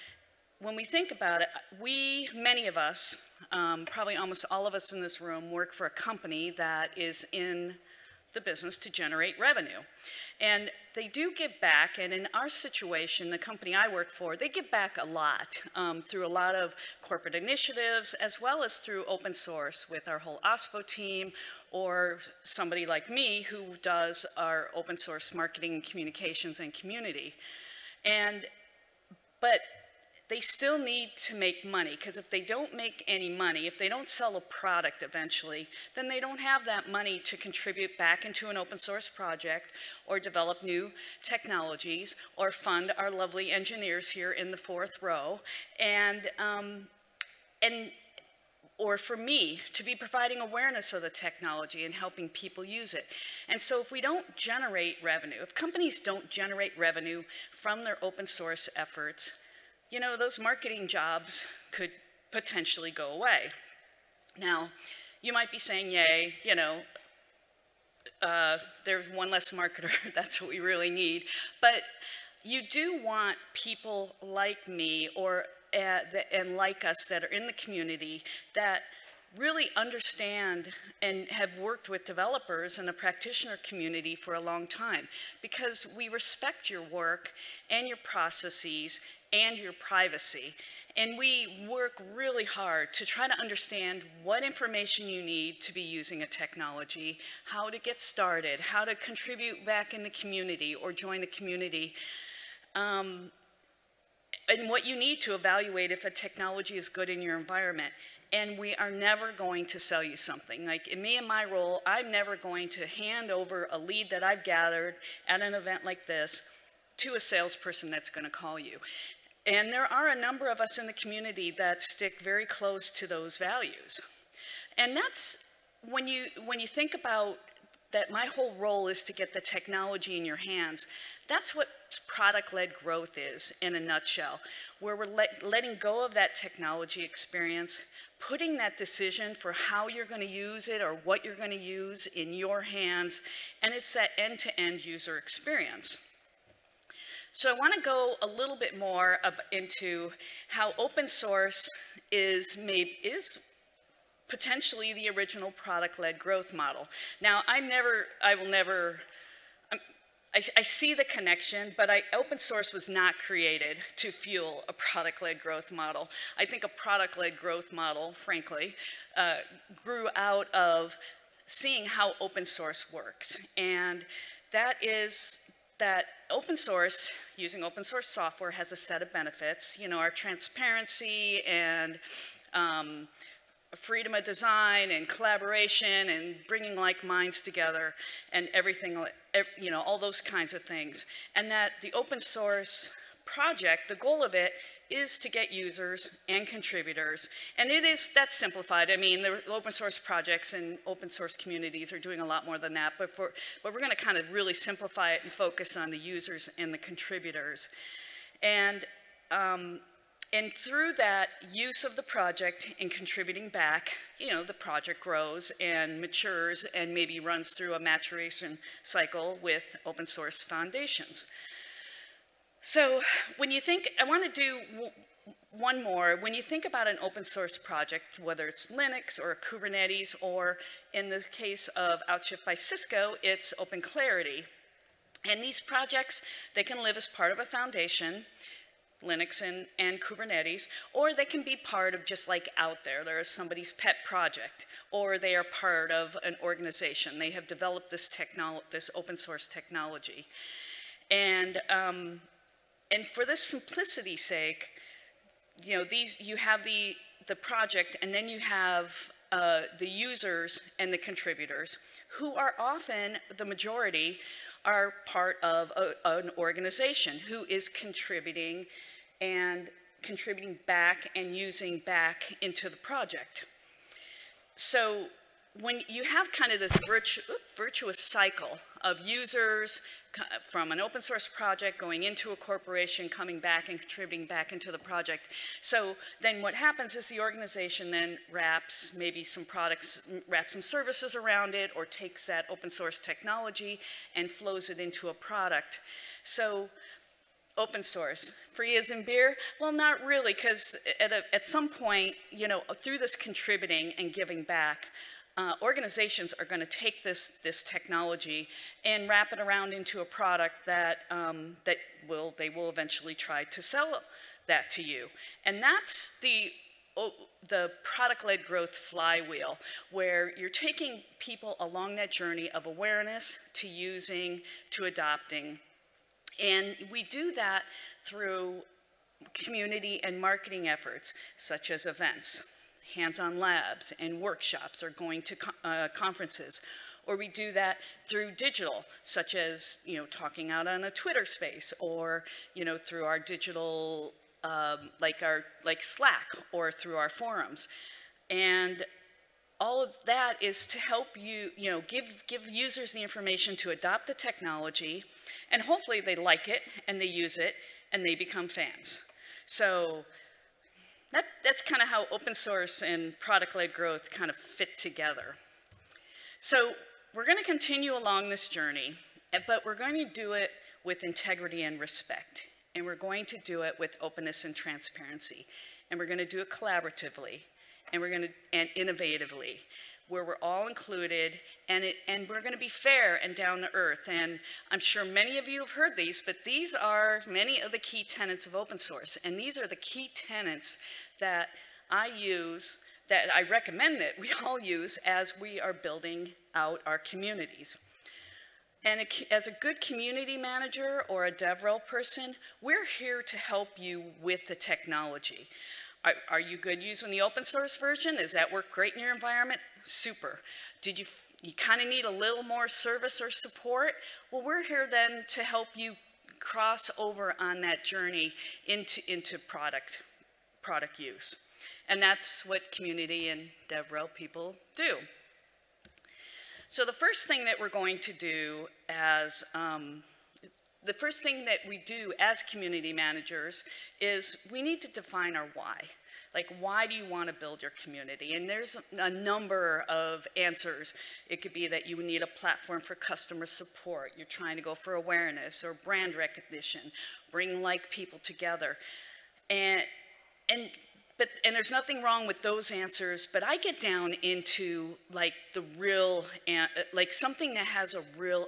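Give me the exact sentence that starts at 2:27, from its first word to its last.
So I want to go a little bit more into how open source is, made, is potentially the original product-led growth model.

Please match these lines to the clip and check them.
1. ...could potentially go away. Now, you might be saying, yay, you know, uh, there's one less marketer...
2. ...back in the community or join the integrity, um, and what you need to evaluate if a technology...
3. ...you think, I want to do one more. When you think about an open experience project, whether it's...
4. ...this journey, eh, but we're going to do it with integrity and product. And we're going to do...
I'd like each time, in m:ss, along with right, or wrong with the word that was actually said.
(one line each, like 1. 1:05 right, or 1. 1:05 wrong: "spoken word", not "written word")
1. 1:01 right
2. 1:39 wrong: "community", not "integrity"
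3. 3:43 wrong: "source", not "experience"
4. 6:08 wrong: "respect", not "product".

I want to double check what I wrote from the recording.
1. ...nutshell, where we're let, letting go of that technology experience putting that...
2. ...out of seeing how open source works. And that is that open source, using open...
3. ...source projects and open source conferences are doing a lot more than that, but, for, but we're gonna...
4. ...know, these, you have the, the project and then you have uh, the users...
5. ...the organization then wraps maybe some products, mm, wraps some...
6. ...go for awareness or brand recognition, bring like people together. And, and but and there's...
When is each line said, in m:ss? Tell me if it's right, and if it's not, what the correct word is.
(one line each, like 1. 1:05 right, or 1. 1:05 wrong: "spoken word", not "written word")
1. 2:13 right
2. 2:50 right
3. 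3:19 wrong: "communities", not "conferences"
4. 4:15 right
5. 4:47 right
6. 7:24 right.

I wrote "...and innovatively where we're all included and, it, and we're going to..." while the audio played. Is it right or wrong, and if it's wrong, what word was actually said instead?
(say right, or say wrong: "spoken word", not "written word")
right.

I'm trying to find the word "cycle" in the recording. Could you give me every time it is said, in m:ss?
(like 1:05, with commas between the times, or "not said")
3:38, 4:38.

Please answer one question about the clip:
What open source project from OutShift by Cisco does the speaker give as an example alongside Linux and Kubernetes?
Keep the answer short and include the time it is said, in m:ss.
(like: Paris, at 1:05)
OpenClarity, at 3:53.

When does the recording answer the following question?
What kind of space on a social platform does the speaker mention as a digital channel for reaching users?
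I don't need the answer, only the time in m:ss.
5:40.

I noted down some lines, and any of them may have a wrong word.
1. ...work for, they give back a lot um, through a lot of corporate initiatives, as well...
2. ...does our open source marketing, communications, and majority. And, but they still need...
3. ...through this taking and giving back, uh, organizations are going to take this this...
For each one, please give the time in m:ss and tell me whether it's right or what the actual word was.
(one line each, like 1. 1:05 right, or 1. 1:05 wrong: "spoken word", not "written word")
1. 0:13 right
2. 0:23 wrong: "community", not "majority"
3. 5:02 wrong: "contributing", not "taking".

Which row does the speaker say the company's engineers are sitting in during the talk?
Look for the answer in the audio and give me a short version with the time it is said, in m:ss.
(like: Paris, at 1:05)
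Fourth row, at 0:44.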